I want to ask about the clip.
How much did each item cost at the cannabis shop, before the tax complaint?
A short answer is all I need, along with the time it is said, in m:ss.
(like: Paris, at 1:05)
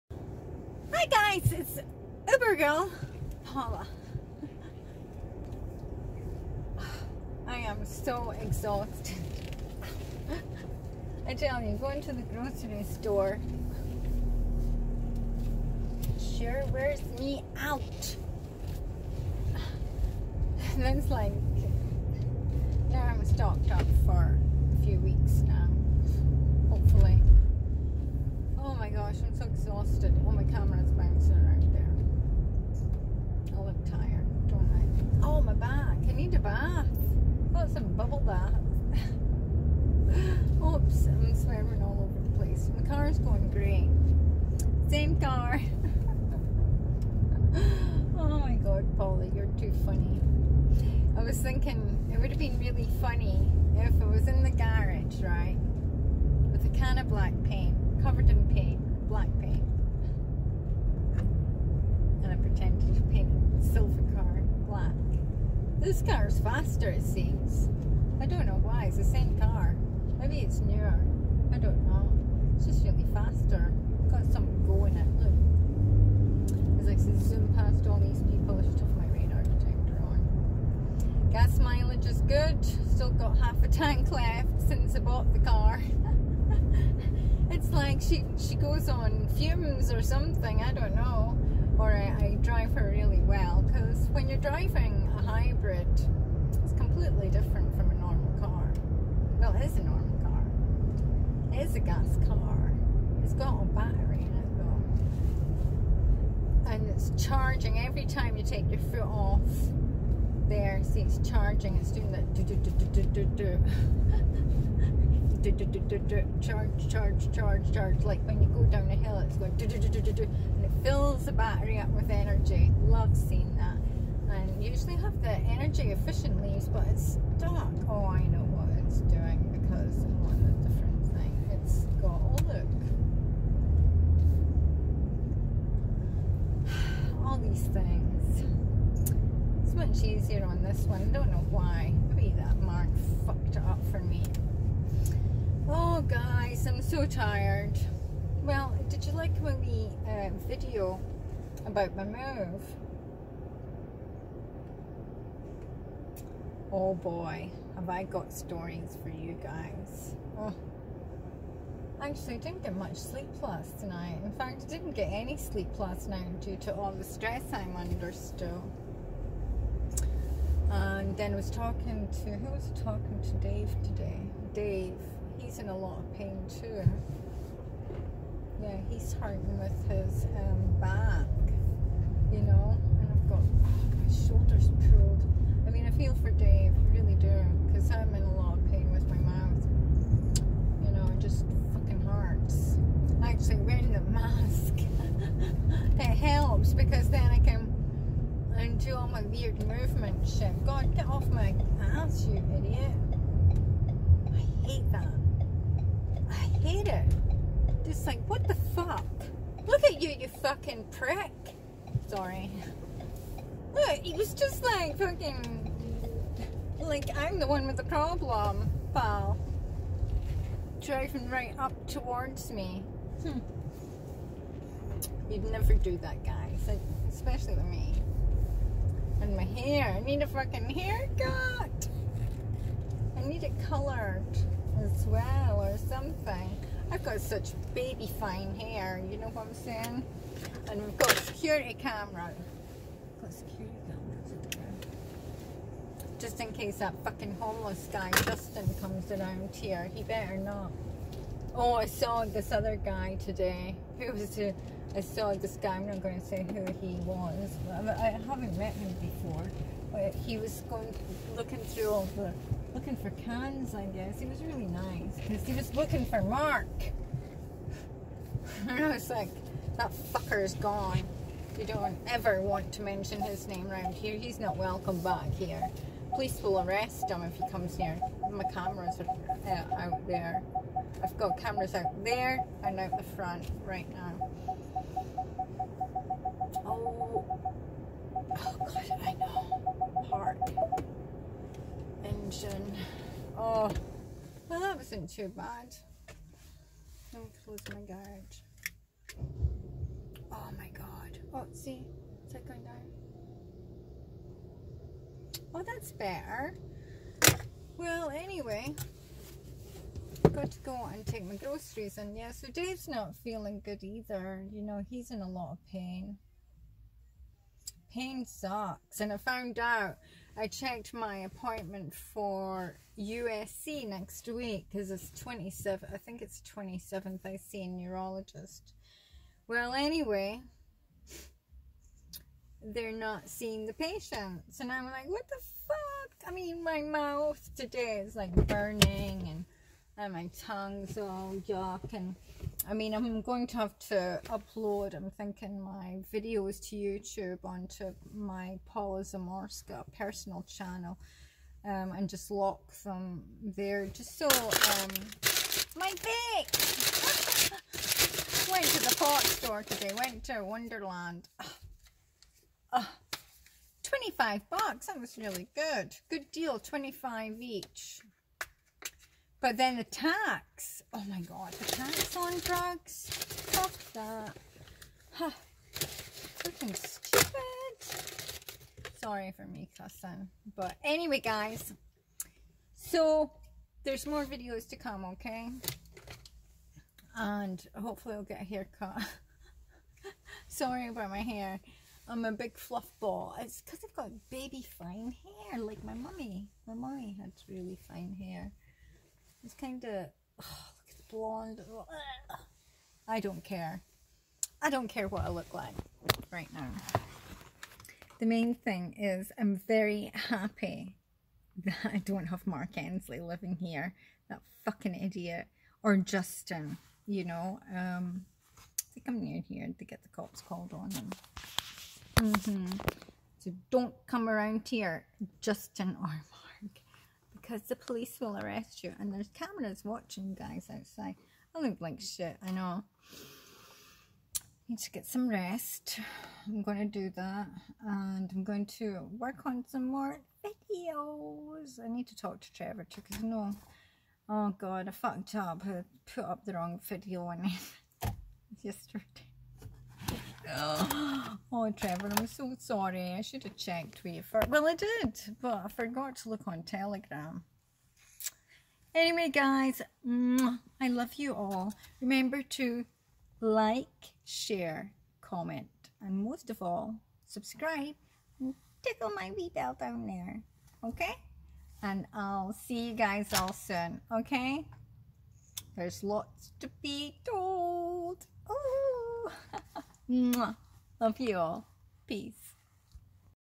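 $25, at 6:06.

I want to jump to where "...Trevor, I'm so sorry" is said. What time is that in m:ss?
7:31.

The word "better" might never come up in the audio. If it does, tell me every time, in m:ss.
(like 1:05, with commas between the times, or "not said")
4:10, 5:05.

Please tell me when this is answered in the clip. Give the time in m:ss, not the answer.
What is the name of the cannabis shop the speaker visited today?
6:00.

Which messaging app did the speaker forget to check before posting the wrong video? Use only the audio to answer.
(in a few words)
Telegram.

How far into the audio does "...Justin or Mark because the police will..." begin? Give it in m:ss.
7:05.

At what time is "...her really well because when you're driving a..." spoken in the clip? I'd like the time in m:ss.
1:32.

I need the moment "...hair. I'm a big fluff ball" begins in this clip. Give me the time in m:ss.
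6:31.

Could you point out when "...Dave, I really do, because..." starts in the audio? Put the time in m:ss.
3:06.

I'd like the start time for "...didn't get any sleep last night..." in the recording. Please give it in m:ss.
2:44.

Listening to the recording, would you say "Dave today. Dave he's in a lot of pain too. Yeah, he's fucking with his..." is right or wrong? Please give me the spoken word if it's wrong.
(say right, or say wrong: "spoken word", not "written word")
wrong: "hurting", not "fucking".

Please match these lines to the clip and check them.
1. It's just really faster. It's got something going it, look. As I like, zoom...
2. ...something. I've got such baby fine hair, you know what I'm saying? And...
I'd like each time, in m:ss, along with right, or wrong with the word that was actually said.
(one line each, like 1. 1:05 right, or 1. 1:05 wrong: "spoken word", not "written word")
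1. 1:12 right
2. 3:55 right.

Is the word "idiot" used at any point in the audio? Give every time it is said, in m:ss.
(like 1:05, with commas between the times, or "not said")
3:22, 6:54.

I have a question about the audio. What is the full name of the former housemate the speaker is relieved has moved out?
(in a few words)
Mark Ensley.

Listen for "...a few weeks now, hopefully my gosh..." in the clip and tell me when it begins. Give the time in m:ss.
0:24.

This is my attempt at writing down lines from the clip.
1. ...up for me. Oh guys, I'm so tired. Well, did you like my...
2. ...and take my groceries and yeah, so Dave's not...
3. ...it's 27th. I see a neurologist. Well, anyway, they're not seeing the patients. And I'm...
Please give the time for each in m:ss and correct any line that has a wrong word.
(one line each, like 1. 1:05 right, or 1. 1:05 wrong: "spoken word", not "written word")
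1. 2:23 right
2. 5:10 right
3. 5:26 right.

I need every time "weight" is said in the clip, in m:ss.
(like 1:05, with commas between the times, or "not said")
not said.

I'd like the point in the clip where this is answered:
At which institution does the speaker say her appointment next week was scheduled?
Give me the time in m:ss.
5:22.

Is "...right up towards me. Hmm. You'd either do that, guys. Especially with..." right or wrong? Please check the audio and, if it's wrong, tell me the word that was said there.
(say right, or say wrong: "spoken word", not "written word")
wrong: "never", not "either".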